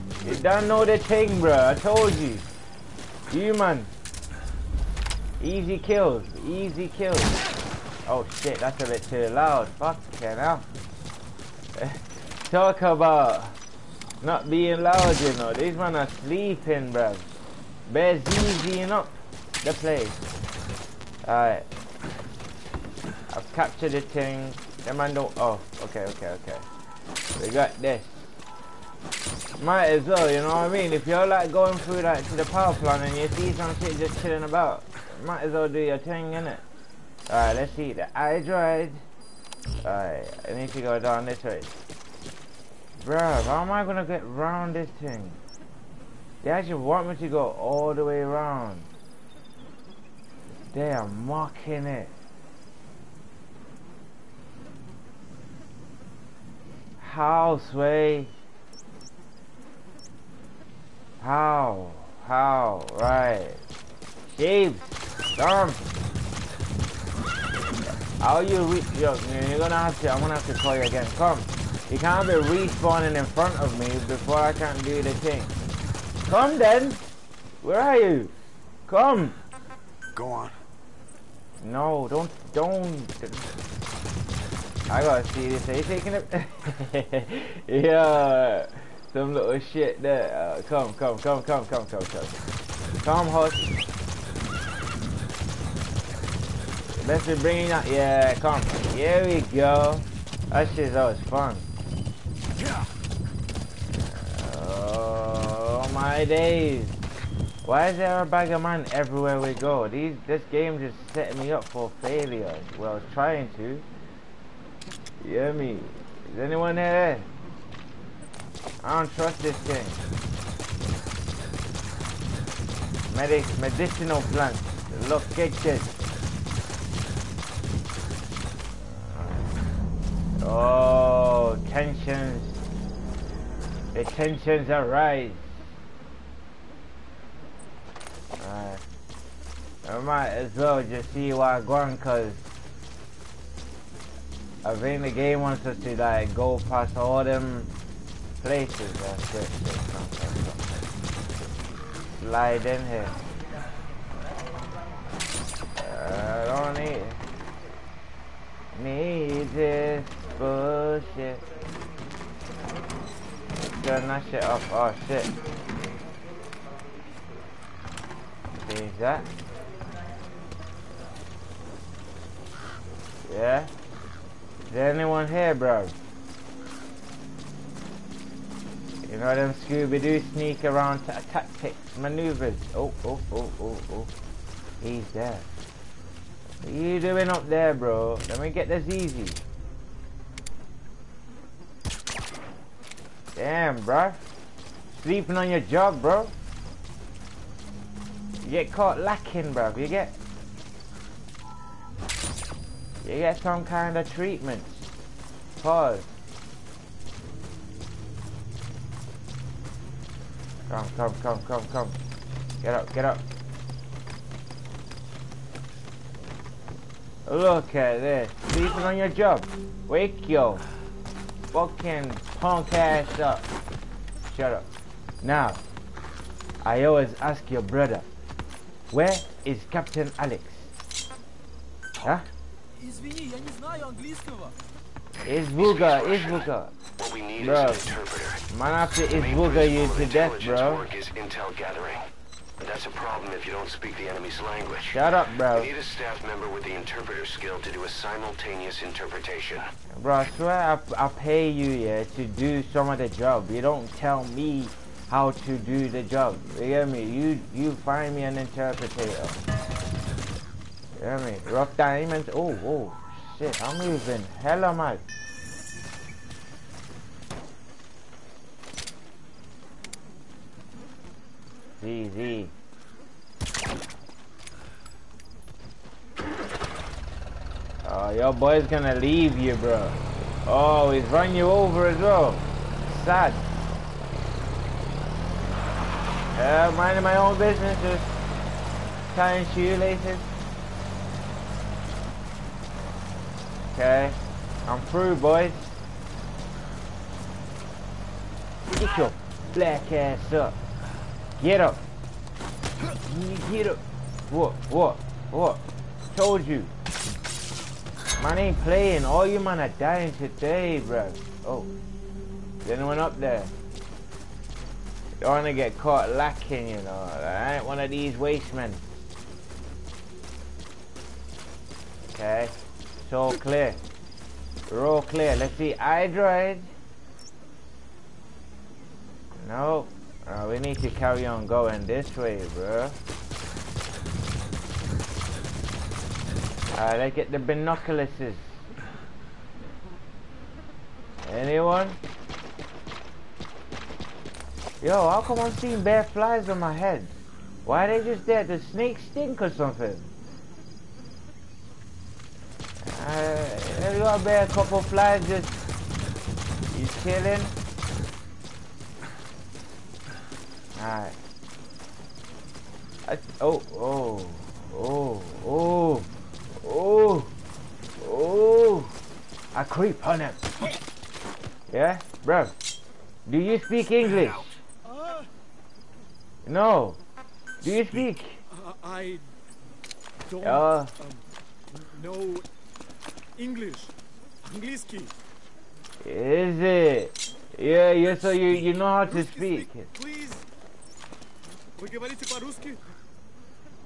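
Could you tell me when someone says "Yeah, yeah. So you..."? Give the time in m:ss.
6:27.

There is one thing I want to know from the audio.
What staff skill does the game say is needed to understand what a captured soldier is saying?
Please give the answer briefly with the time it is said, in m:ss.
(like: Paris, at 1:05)
interpreter skill, at 4:06.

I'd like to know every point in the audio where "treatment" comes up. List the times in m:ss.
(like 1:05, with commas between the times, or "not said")
3:24.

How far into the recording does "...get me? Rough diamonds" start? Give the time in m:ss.
4:21.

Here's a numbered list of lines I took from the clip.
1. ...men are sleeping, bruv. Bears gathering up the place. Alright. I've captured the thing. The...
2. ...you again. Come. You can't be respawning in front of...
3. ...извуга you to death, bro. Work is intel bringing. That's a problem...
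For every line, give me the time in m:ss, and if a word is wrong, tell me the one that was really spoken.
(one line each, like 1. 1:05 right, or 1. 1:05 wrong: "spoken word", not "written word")
1. 0:15 wrong: "easying", not "gathering"
2. 1:10 right
3. 3:59 wrong: "gathering", not "bringing".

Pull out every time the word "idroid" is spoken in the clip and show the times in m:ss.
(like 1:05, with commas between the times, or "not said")
0:38, 5:25.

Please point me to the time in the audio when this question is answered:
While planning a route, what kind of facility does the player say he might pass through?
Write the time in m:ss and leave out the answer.
0:32.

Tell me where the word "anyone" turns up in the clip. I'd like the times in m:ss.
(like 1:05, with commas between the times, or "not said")
1:56, 2:54, 5:12, 5:41.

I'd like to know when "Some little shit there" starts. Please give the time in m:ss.
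1:29.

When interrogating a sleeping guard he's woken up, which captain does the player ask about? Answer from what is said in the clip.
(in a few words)
Captain Alex.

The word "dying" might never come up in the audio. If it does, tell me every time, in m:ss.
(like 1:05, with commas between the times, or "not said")
5:09.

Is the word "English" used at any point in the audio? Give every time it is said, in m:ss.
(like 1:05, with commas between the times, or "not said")
6:13, 6:23.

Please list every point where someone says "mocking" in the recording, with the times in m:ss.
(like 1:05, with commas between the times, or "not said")
0:51.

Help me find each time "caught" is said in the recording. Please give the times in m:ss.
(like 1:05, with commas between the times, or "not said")
3:18, 5:15.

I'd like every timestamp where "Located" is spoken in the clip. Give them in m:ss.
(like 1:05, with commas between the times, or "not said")
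2:05.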